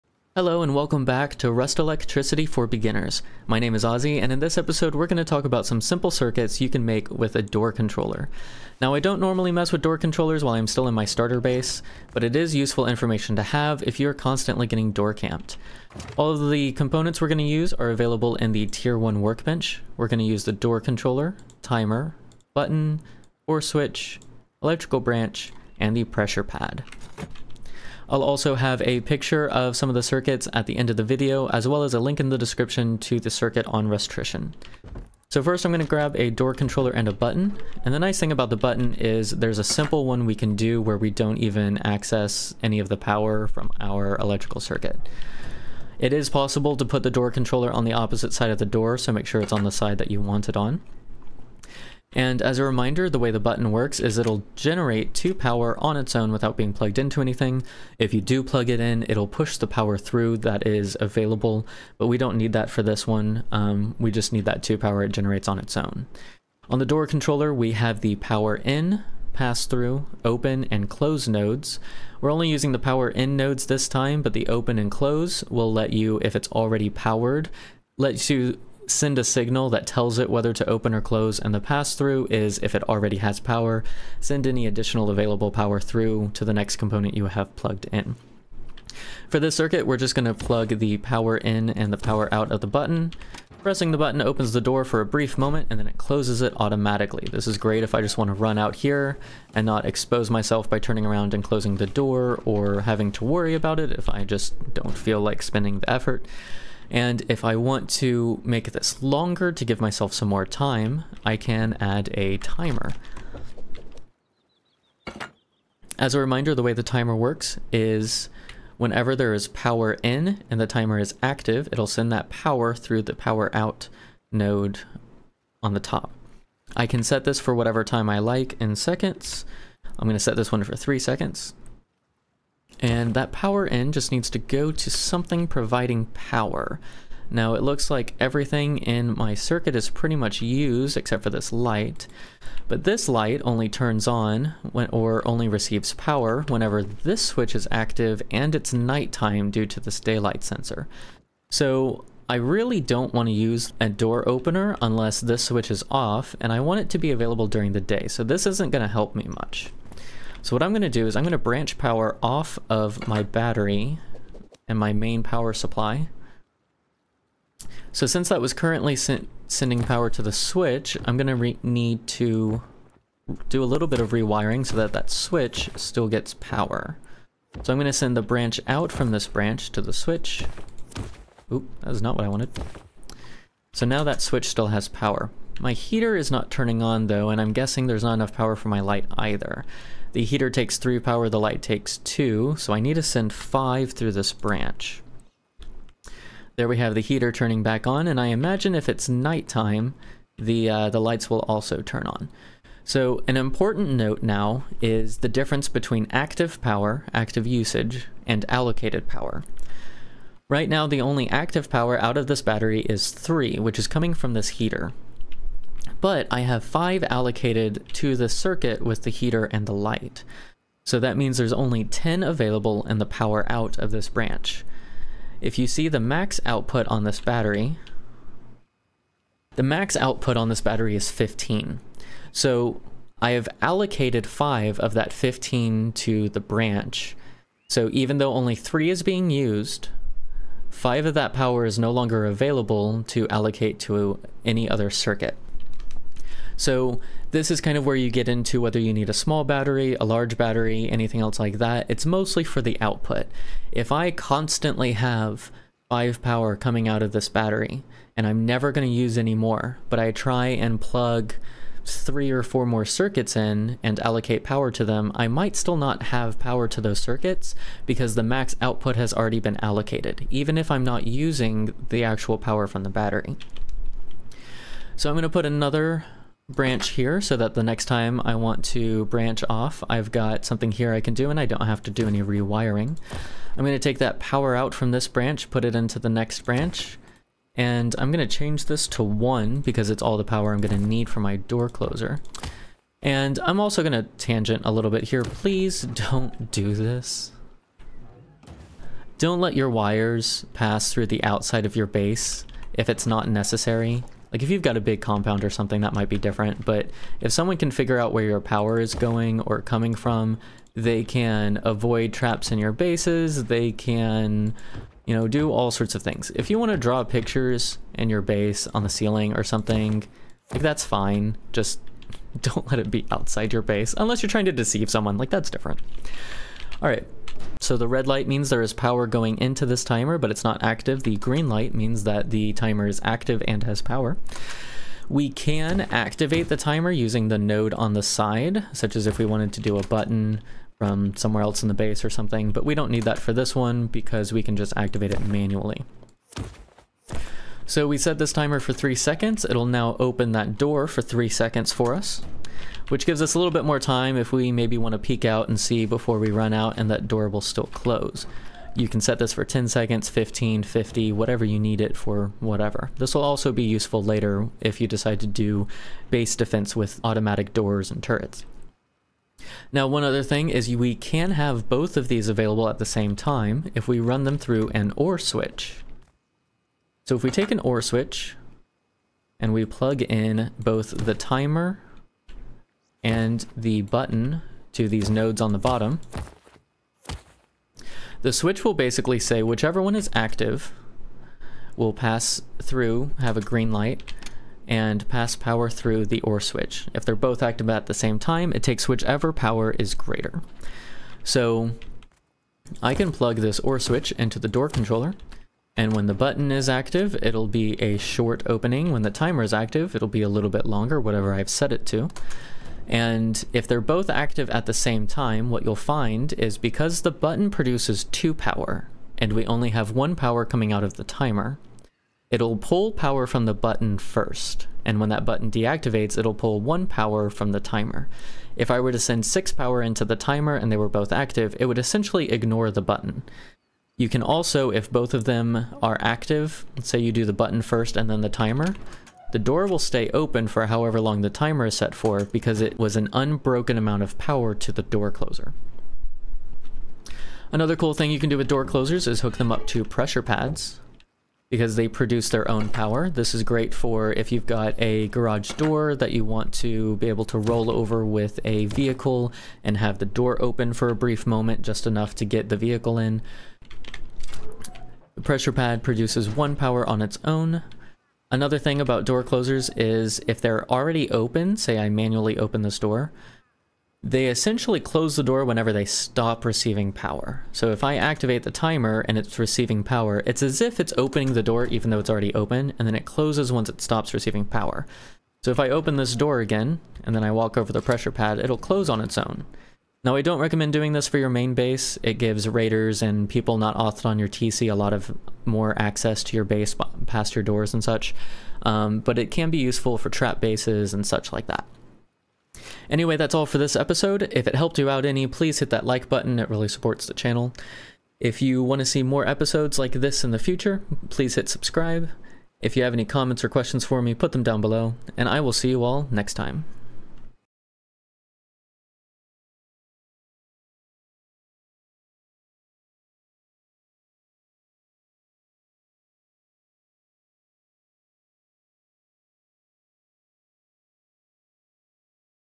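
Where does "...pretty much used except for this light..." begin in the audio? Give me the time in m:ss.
2:19.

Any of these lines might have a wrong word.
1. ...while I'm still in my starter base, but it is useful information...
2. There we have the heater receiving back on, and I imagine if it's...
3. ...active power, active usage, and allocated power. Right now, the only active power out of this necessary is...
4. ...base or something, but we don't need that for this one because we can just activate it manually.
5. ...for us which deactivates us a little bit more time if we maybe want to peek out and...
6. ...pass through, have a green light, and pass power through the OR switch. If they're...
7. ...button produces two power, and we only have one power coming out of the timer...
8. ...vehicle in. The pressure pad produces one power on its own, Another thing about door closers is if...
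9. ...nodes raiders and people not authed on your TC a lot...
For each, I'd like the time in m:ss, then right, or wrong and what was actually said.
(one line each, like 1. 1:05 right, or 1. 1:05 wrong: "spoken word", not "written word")
1. 0:10 right
2. 3:16 wrong: "turning", not "receiving"
3. 3:26 wrong: "battery", not "necessary"
4. 5:41 right
5. 5:51 wrong: "gives", not "deactivates"
6. 6:31 right
7. 6:57 right
8. 7:42 right
9. 8:12 wrong: "gives", not "nodes".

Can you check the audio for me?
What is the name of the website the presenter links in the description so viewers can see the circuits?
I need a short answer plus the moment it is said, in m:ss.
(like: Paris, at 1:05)
Rustrician, at 0:33.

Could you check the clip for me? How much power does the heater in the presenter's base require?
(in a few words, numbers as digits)
3.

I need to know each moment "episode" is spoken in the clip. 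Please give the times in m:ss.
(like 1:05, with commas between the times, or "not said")
0:04, 8:23, 8:29.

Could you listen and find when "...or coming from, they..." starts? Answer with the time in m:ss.
5:09.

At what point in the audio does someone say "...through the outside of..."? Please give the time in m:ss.
5:00.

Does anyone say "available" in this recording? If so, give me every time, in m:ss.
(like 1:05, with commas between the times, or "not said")
0:17, 1:00, 1:25, 2:37, 3:42, 4:02, 6:12.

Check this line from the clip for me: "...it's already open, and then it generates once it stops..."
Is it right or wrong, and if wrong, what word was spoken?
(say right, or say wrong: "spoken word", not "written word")
wrong: "closes", not "generates".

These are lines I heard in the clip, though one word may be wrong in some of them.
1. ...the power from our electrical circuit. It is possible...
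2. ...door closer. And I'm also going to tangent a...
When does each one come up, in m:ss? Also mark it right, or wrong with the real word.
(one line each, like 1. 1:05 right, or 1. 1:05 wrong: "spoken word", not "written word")
1. 0:42 right
2. 4:51 right.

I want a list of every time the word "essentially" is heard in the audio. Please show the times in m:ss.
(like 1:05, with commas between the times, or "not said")
7:11, 7:54.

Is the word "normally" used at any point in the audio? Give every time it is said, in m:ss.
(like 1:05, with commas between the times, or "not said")
0:09.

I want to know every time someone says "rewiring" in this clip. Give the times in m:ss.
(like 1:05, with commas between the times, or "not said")
2:54, 4:42.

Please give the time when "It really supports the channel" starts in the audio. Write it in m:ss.
8:26.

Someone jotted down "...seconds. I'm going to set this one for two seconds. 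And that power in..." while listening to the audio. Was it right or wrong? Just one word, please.
wrong.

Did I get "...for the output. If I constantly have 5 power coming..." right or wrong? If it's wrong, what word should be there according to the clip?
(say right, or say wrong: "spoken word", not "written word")
right.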